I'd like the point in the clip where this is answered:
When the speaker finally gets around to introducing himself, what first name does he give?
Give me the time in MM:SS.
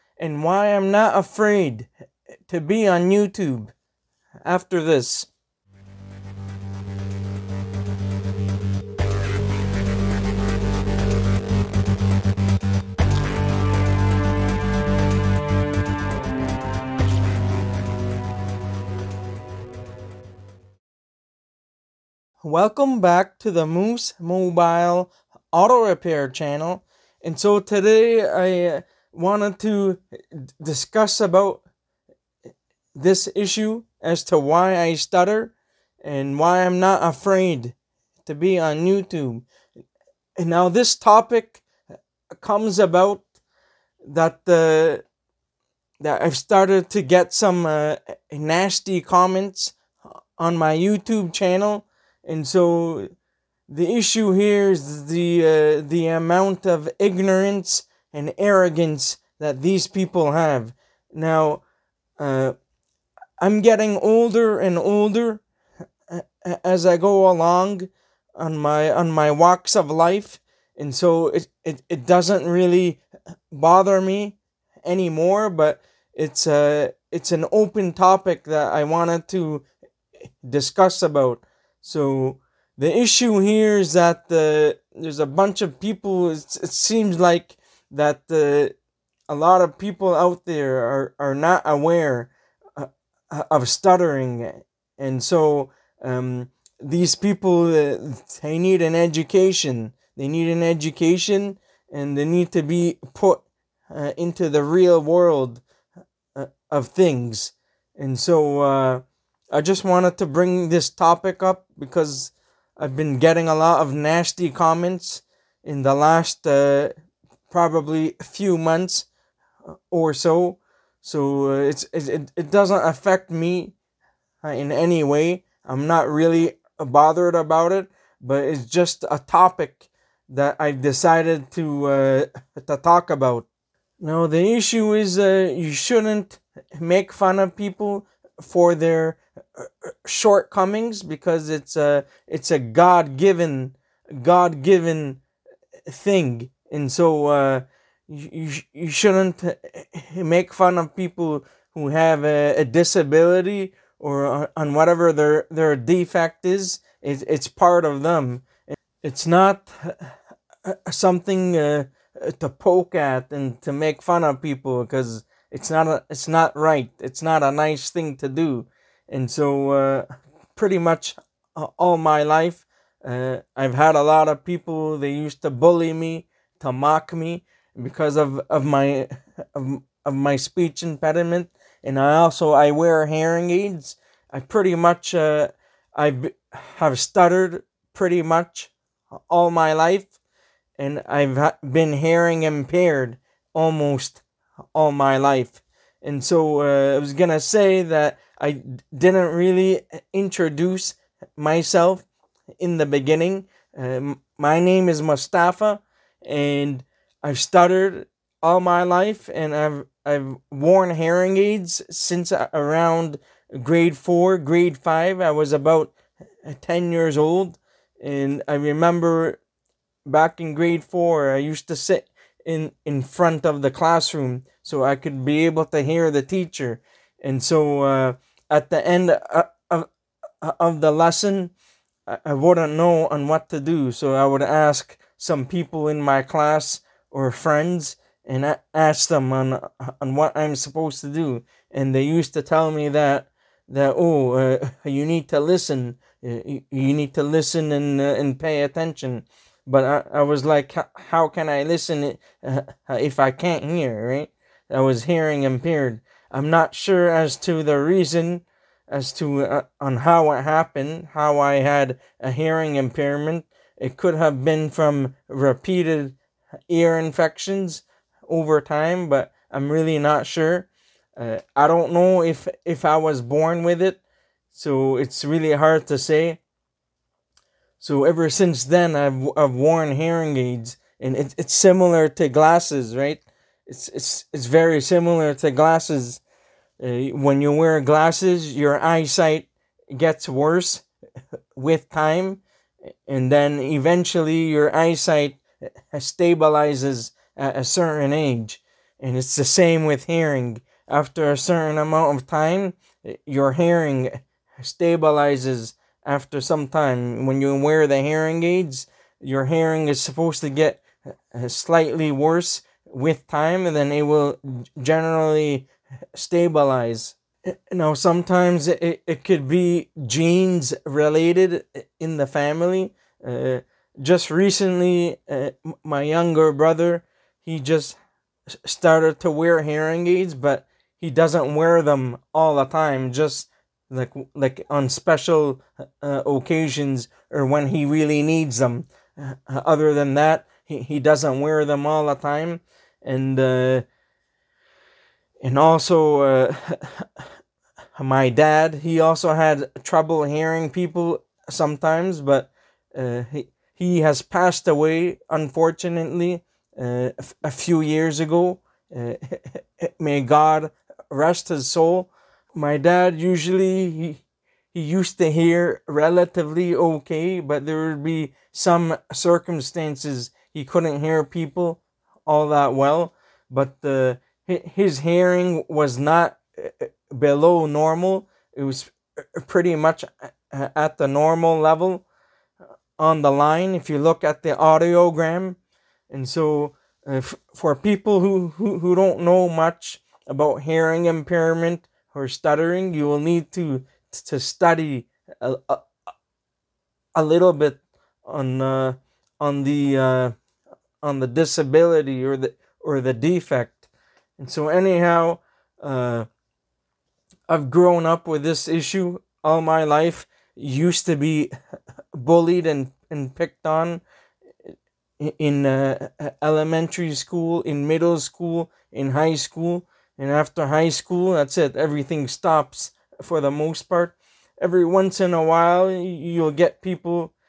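03:25.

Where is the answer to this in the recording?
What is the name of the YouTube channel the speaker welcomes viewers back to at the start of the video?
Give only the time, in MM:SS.
00:23.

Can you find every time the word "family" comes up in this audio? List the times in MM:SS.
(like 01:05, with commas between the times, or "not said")
05:22.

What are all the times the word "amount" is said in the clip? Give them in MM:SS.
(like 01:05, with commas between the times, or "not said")
00:56, 05:01.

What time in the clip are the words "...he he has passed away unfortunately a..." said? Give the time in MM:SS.
05:53.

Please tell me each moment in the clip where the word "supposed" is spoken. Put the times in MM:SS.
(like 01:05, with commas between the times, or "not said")
04:00, 05:10.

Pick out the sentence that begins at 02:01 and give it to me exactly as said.
So uh, it's it, it doesn't affect me uh, in any way.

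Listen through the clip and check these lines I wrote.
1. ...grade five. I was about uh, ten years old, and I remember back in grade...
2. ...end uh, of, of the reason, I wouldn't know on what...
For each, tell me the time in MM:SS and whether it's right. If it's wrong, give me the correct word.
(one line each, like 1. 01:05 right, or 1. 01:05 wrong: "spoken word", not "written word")
1. 03:34 right
2. 03:48 wrong: "lesson", not "reason".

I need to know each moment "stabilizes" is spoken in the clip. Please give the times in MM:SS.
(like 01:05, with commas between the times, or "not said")
04:55, 05:04, 05:16.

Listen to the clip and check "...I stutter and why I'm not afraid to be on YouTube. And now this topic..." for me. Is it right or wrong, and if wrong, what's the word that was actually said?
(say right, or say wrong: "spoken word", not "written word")
right.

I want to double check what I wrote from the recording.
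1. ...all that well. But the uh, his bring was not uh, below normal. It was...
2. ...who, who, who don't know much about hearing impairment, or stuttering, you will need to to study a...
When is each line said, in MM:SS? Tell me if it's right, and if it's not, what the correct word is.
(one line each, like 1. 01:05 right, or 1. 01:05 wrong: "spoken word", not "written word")
1. 06:12 wrong: "hearing", not "bring"
2. 06:28 right.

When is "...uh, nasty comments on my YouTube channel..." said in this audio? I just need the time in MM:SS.
00:47.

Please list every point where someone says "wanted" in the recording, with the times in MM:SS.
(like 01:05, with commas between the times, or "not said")
00:29, 01:18, 01:49.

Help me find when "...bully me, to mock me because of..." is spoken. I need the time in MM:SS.
02:55.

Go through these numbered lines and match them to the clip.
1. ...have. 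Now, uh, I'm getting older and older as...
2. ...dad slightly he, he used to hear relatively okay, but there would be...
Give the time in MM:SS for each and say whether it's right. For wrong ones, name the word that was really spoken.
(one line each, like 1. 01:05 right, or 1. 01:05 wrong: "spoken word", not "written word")
1. 01:00 right
2. 06:02 wrong: "usually", not "slightly".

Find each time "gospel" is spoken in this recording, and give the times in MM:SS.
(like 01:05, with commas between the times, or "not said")
not said.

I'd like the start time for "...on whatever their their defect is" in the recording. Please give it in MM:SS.
02:34.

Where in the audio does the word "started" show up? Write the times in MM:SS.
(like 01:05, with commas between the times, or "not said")
00:46, 05:28.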